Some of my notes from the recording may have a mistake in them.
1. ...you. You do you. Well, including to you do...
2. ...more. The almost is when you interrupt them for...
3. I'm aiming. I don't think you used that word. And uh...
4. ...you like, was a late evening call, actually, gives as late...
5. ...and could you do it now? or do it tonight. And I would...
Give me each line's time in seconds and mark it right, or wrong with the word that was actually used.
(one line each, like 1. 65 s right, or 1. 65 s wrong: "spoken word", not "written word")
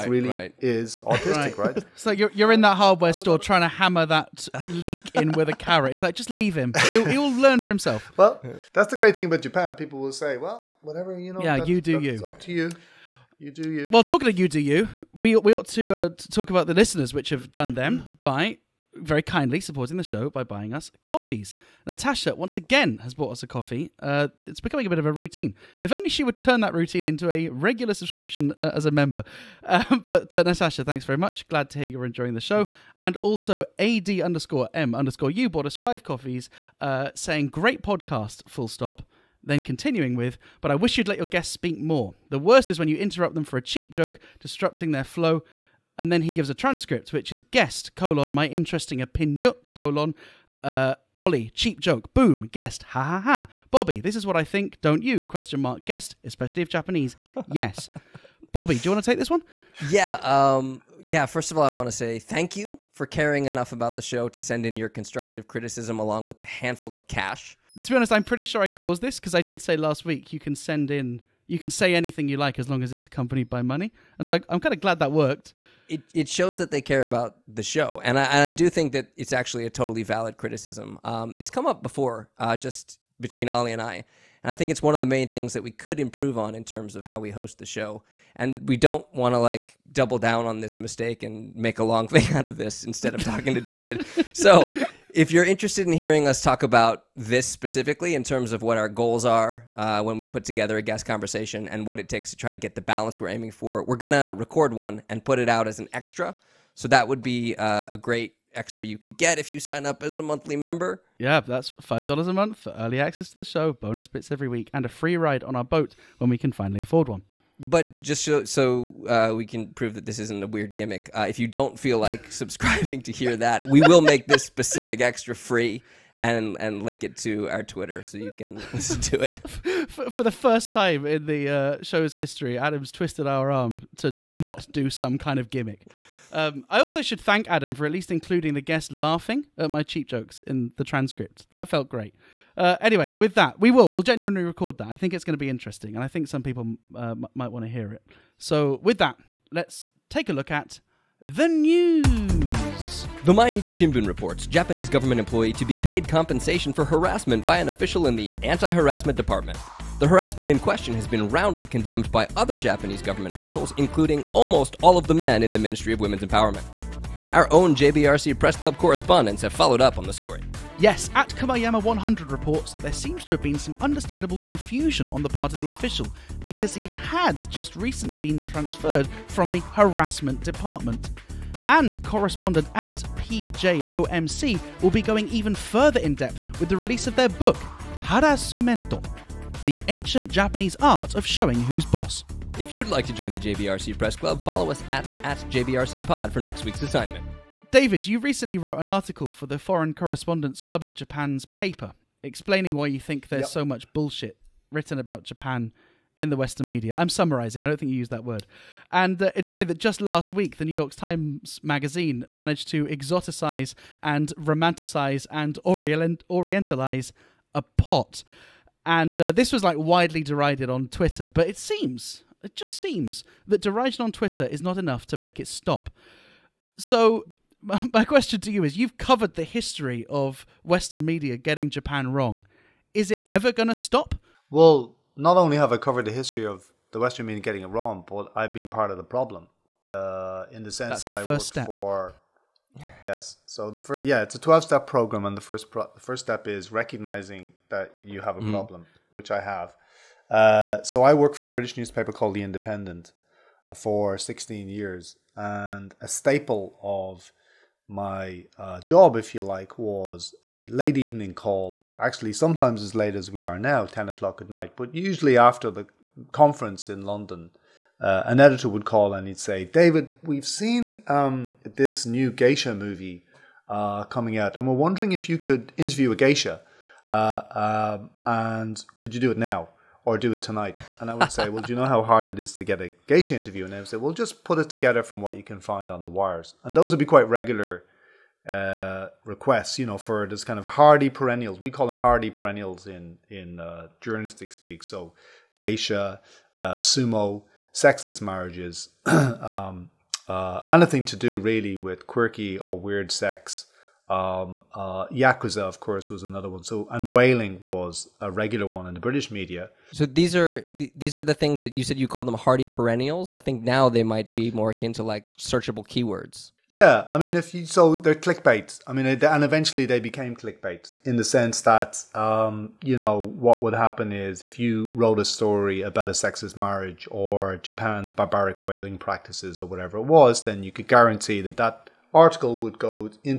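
1. 12 s wrong: "talking", not "including"
2. 41 s wrong: "worst", not "almost"
3. 206 s wrong: "summarizing", not "aiming"
4. 259 s wrong: "sometimes", not "gives"
5. 278 s right.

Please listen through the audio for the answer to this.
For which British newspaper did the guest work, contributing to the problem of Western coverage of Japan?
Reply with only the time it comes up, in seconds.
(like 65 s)
252 s.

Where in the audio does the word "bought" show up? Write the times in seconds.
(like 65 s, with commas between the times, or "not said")
23 s, 35 s.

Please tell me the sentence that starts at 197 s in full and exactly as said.
David, you recently wrote an article for the Foreign Correspondents Club of Japan's paper explaining why you think there's yep.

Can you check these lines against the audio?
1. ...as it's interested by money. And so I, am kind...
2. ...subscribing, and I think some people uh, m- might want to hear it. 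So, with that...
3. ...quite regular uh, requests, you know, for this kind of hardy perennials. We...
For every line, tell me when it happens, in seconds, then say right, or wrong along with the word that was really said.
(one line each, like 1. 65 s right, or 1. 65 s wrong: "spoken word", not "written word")
1. 72 s wrong: "accompanied", not "interested"
2. 145 s wrong: "interesting", not "subscribing"
3. 287 s right.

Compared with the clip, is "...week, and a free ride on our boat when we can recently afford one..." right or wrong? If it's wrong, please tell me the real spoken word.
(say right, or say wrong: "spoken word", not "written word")
wrong: "finally", not "recently".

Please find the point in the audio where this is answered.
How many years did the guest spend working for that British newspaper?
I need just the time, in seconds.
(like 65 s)
254 s.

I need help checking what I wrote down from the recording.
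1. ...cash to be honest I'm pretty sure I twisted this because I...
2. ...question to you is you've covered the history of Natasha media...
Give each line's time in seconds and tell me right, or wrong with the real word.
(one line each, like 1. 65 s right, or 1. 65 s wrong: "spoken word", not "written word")
1. 67 s wrong: "caused", not "twisted"
2. 228 s wrong: "Western", not "Natasha".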